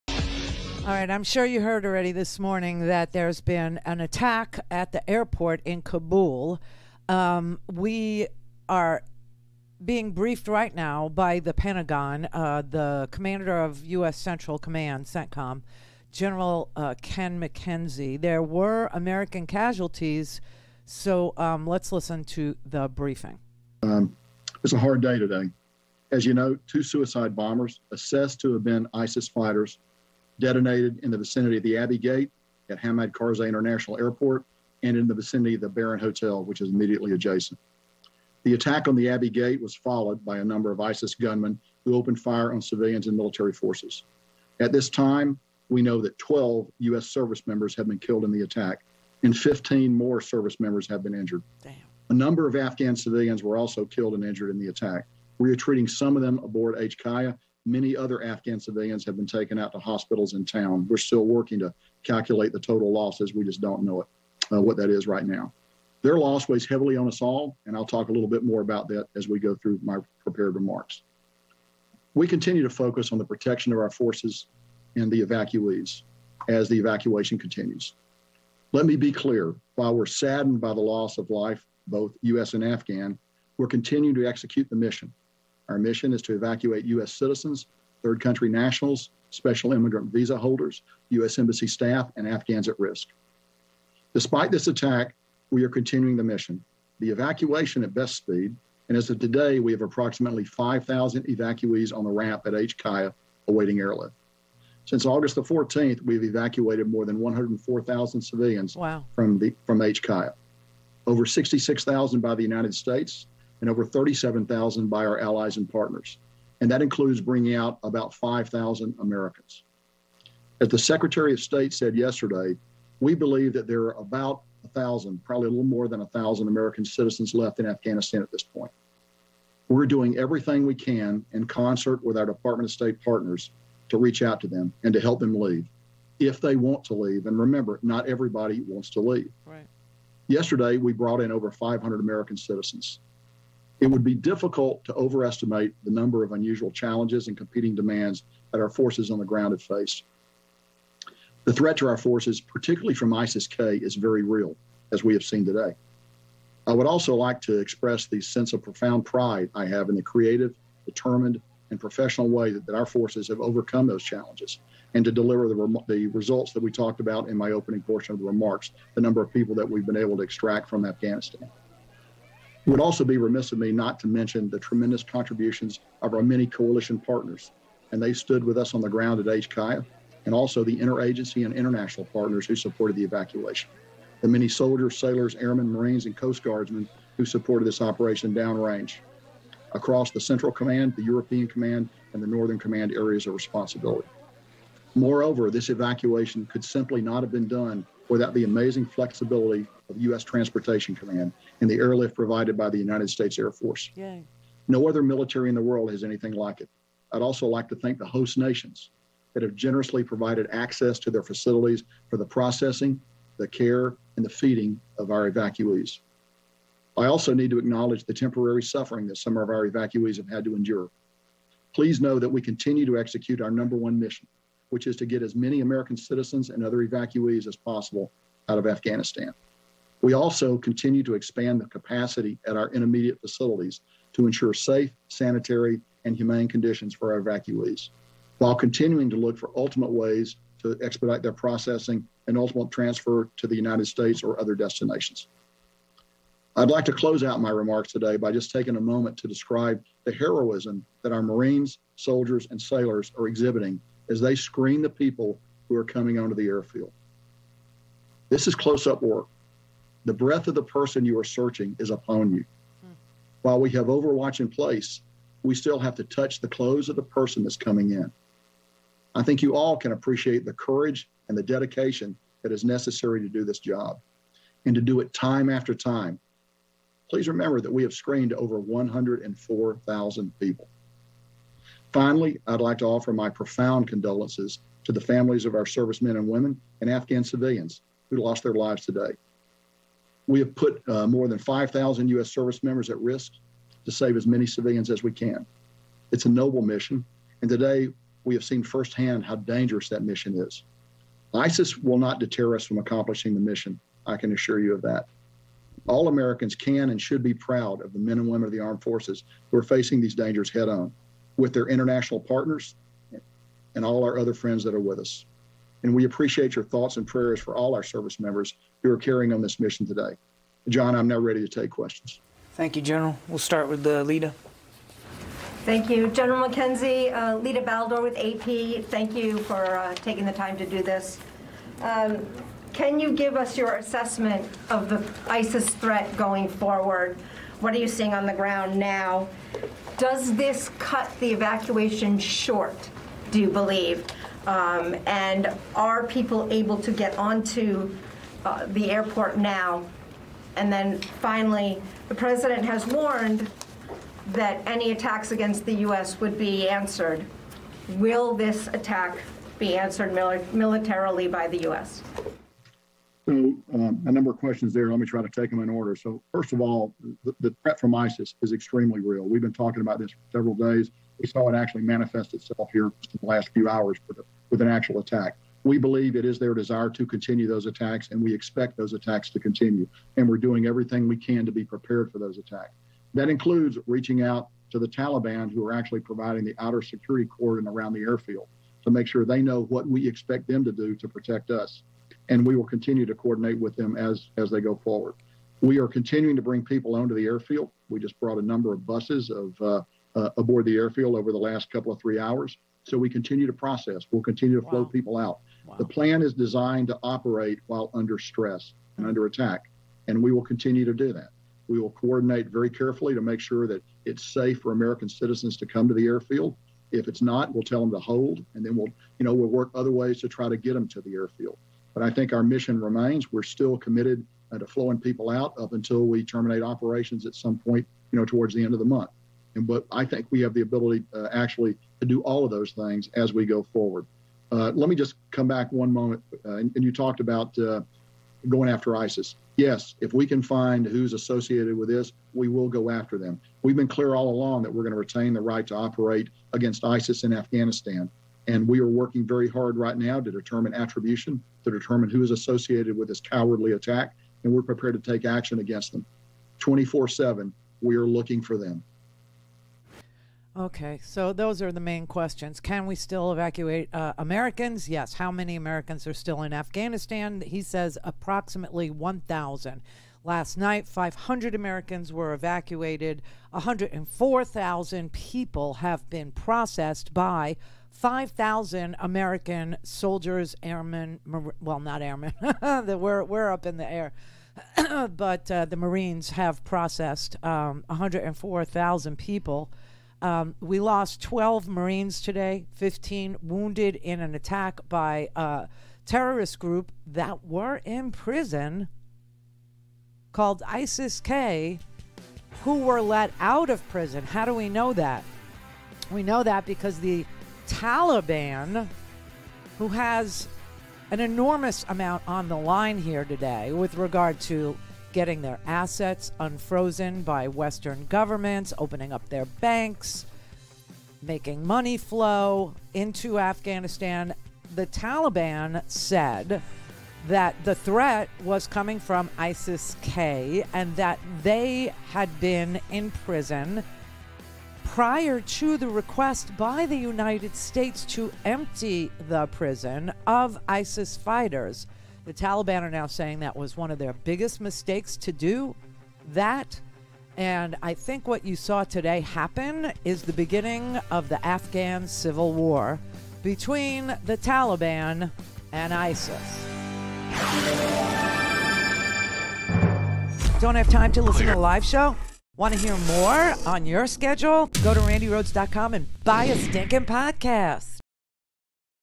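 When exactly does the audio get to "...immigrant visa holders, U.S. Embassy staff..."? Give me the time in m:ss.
1:29.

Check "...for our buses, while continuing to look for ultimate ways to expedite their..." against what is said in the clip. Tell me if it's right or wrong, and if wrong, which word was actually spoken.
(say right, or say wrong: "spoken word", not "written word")
wrong: "evacuees", not "buses".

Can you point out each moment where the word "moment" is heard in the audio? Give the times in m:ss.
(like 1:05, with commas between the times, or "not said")
4:08, 7:15.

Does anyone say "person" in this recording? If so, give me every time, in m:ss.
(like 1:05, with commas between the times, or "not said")
4:20, 4:27.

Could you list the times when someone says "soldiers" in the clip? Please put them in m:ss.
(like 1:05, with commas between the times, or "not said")
3:04, 4:11, 7:59.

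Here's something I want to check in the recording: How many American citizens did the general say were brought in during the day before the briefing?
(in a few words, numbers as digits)
over 500.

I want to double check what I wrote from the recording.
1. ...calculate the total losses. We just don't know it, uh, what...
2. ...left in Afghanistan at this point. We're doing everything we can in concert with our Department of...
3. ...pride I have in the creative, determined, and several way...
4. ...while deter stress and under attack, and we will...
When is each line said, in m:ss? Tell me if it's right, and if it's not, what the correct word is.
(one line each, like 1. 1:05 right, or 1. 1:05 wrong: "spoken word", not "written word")
1. 1:02 right
2. 2:07 right
3. 2:39 wrong: "professional", not "several"
4. 6:47 wrong: "under", not "deter".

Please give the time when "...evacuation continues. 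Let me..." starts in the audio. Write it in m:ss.
1:16.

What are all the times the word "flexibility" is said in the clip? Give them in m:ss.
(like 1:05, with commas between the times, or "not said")
3:18.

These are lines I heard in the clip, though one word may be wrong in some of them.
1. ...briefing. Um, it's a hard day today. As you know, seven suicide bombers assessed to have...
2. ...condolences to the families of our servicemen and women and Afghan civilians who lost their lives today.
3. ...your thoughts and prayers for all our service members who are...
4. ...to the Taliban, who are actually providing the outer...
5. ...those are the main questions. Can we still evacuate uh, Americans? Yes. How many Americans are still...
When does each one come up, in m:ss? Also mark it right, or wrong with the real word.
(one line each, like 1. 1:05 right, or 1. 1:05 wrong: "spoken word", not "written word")
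1. 0:22 wrong: "two", not "seven"
2. 4:43 right
3. 5:16 right
4. 6:24 right
5. 7:41 right.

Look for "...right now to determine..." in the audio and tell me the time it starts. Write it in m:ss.
7:29.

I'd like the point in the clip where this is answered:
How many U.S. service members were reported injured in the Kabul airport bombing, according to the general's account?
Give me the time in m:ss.
0:49.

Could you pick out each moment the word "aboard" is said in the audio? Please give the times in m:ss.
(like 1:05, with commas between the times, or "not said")
0:56, 6:40.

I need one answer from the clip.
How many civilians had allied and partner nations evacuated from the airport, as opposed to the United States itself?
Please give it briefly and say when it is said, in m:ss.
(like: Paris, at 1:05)
over 37,000, at 1:53.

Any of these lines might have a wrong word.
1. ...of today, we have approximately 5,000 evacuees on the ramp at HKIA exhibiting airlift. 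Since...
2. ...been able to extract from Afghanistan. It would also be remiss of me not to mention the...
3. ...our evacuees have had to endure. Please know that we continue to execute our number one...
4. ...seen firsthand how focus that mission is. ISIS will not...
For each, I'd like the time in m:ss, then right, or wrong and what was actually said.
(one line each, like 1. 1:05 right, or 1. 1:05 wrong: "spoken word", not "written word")
1. 1:39 wrong: "awaiting", not "exhibiting"
2. 2:49 right
3. 3:39 right
4. 4:58 wrong: "dangerous", not "focus".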